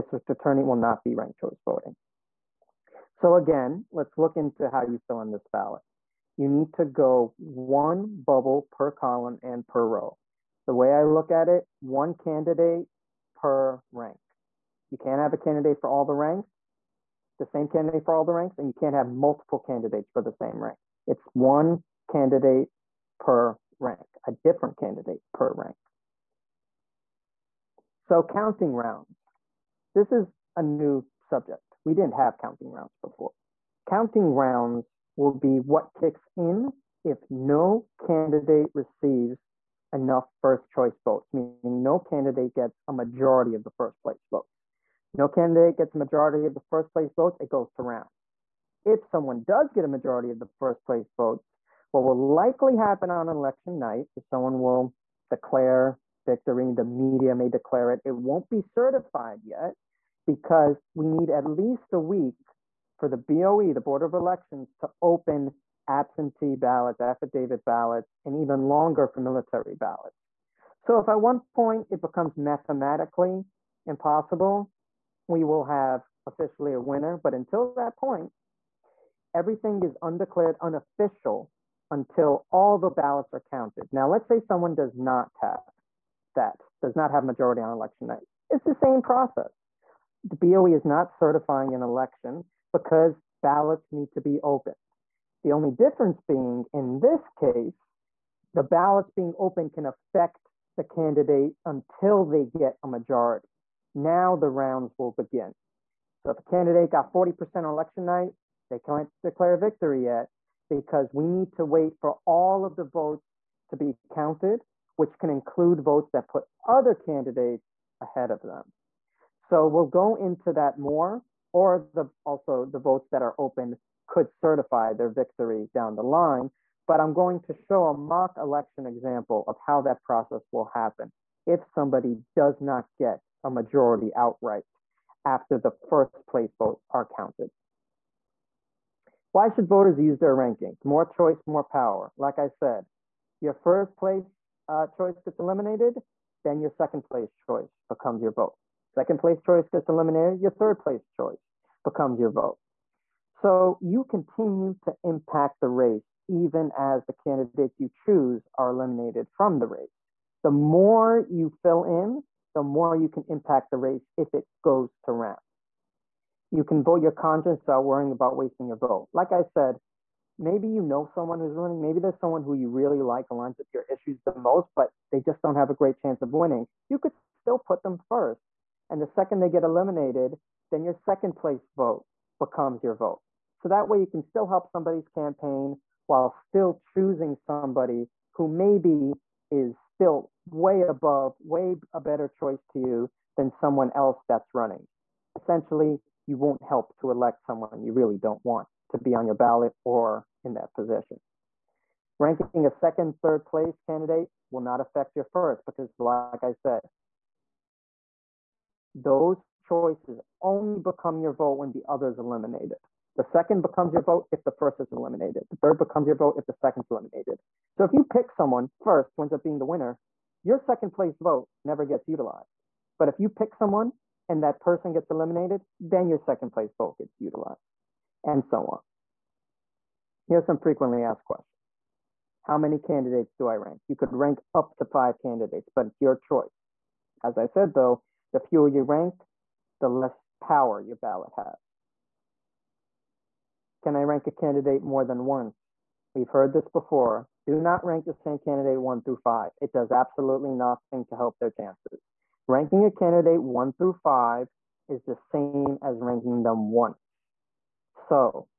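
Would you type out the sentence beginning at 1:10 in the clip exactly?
So if at one point it becomes mathematically impossible, we will have officially a winner.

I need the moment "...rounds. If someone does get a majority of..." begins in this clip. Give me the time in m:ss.
0:47.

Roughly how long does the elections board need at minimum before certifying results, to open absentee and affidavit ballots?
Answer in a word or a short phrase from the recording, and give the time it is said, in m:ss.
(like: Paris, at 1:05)
A week, at 1:01.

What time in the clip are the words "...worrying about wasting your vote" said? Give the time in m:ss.
2:47.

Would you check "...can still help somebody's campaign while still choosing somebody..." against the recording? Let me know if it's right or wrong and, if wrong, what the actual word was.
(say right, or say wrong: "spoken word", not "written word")
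right.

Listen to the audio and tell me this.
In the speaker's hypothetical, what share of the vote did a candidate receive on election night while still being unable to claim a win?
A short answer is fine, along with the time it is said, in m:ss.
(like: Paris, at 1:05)
40%, at 1:47.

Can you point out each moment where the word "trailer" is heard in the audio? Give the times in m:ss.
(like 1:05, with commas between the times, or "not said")
not said.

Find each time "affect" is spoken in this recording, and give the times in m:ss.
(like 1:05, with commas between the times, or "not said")
1:39, 3:24.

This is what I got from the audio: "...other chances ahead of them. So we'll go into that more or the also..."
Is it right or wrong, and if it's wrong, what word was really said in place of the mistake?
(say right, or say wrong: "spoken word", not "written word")
wrong: "candidates", not "chances".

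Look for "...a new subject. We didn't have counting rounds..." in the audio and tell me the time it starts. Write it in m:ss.
0:30.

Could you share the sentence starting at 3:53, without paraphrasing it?
You could rank up to five candidates, but it's your choice.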